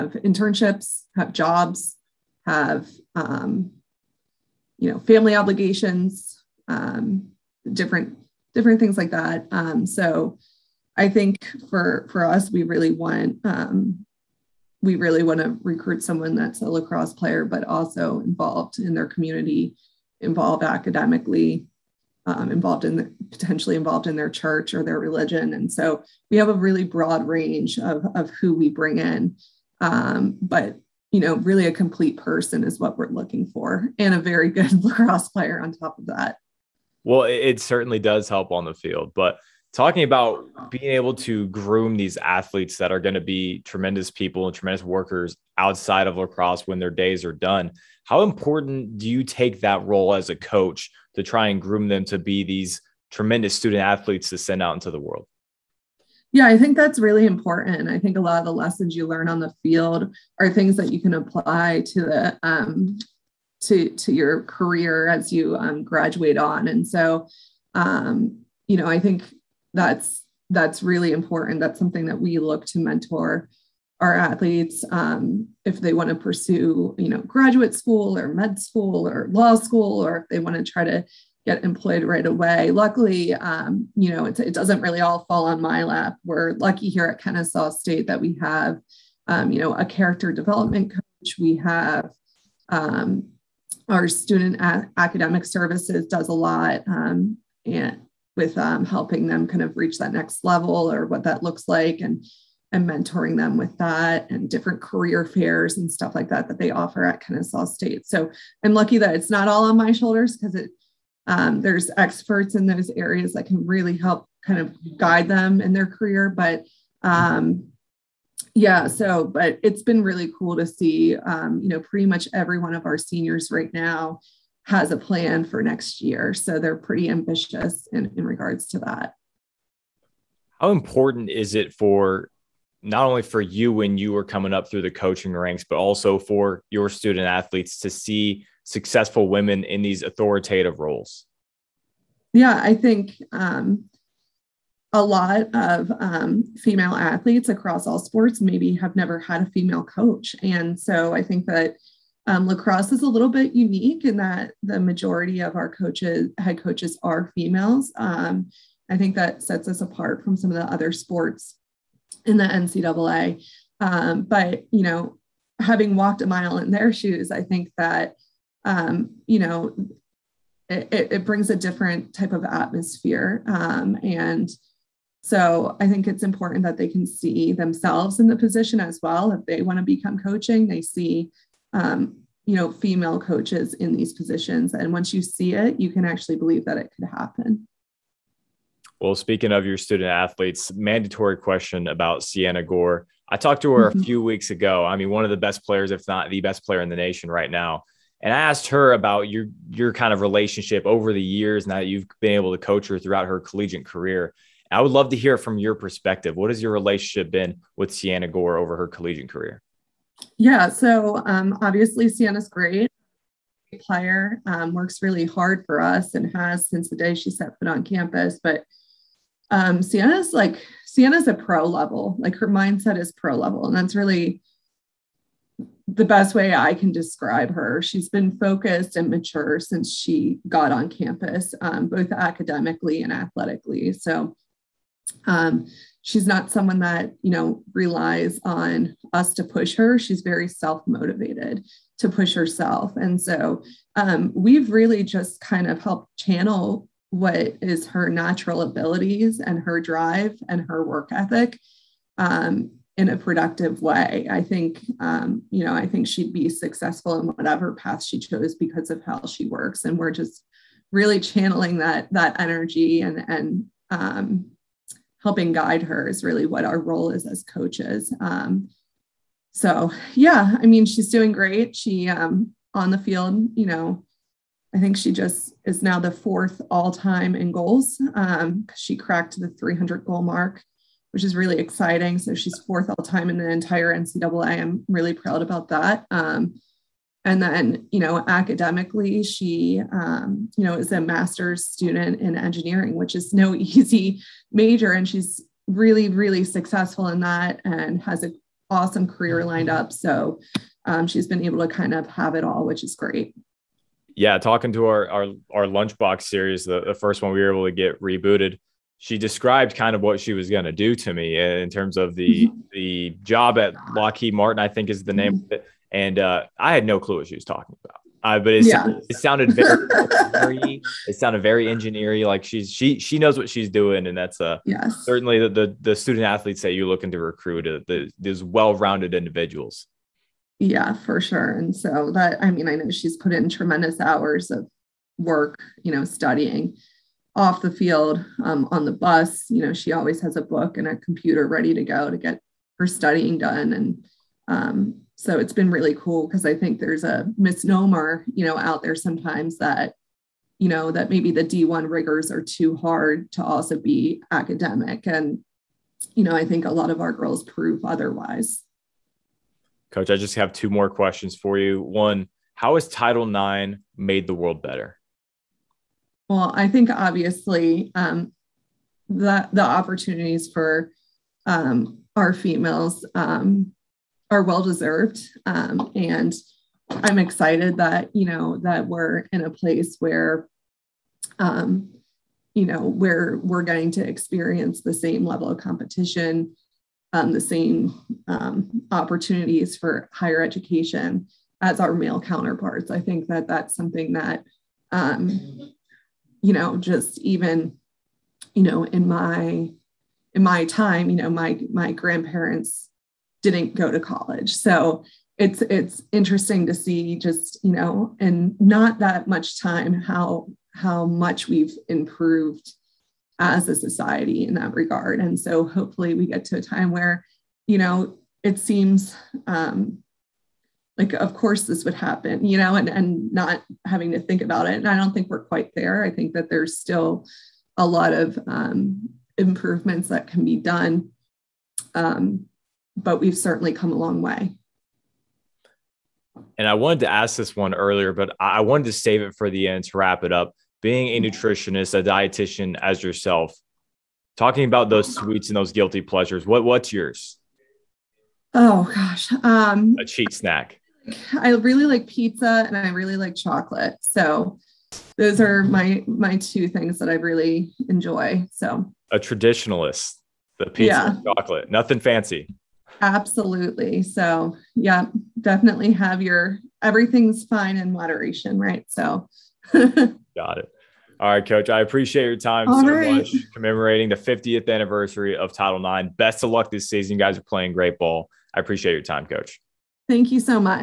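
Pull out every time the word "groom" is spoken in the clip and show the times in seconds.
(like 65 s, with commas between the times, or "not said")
41 s, 51 s.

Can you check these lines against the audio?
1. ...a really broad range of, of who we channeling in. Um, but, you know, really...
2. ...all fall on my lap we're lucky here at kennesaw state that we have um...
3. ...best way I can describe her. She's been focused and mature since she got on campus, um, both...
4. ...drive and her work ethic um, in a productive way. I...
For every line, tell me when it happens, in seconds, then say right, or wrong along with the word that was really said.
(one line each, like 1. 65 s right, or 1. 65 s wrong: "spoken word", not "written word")
1. 26 s wrong: "bring", not "channeling"
2. 84 s right
3. 226 s right
4. 249 s right.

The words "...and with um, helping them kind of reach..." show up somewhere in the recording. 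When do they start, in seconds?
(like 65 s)
97 s.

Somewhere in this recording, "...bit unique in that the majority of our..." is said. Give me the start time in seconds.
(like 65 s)
153 s.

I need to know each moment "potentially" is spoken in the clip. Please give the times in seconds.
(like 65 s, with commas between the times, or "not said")
23 s.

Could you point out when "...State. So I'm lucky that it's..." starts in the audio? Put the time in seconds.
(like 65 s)
107 s.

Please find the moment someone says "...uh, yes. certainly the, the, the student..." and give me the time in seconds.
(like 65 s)
324 s.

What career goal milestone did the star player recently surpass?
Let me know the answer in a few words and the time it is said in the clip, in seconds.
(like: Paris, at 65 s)
300 goals, at 279 s.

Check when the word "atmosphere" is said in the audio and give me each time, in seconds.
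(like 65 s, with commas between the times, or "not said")
172 s.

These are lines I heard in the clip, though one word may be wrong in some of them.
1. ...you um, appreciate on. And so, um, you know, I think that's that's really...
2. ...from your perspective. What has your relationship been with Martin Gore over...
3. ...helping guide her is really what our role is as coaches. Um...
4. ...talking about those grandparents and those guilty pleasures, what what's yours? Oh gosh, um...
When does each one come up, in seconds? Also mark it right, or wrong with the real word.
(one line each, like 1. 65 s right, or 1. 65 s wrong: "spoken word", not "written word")
1. 65 s wrong: "graduate", not "appreciate"
2. 205 s wrong: "Sienna", not "Martin"
3. 265 s right
4. 444 s wrong: "sweets", not "grandparents".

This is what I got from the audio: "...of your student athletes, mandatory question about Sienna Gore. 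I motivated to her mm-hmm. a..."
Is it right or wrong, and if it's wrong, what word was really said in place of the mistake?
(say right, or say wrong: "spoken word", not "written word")
wrong: "talked", not "motivated".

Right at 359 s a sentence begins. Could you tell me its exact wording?
Coach, I just have two more questions for you.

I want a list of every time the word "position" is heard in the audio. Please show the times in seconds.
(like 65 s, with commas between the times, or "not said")
178 s, 184 s.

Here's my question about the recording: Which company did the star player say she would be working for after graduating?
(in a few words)
Lockheed Martin.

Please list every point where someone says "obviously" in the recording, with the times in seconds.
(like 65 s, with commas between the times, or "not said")
211 s, 366 s.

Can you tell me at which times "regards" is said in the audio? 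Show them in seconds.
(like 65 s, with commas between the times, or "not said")
128 s, 414 s.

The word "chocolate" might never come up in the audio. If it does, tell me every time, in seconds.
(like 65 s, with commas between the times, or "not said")
453 s, 461 s.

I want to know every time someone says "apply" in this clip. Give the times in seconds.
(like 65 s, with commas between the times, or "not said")
61 s.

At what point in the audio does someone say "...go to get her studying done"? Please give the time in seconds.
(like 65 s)
341 s.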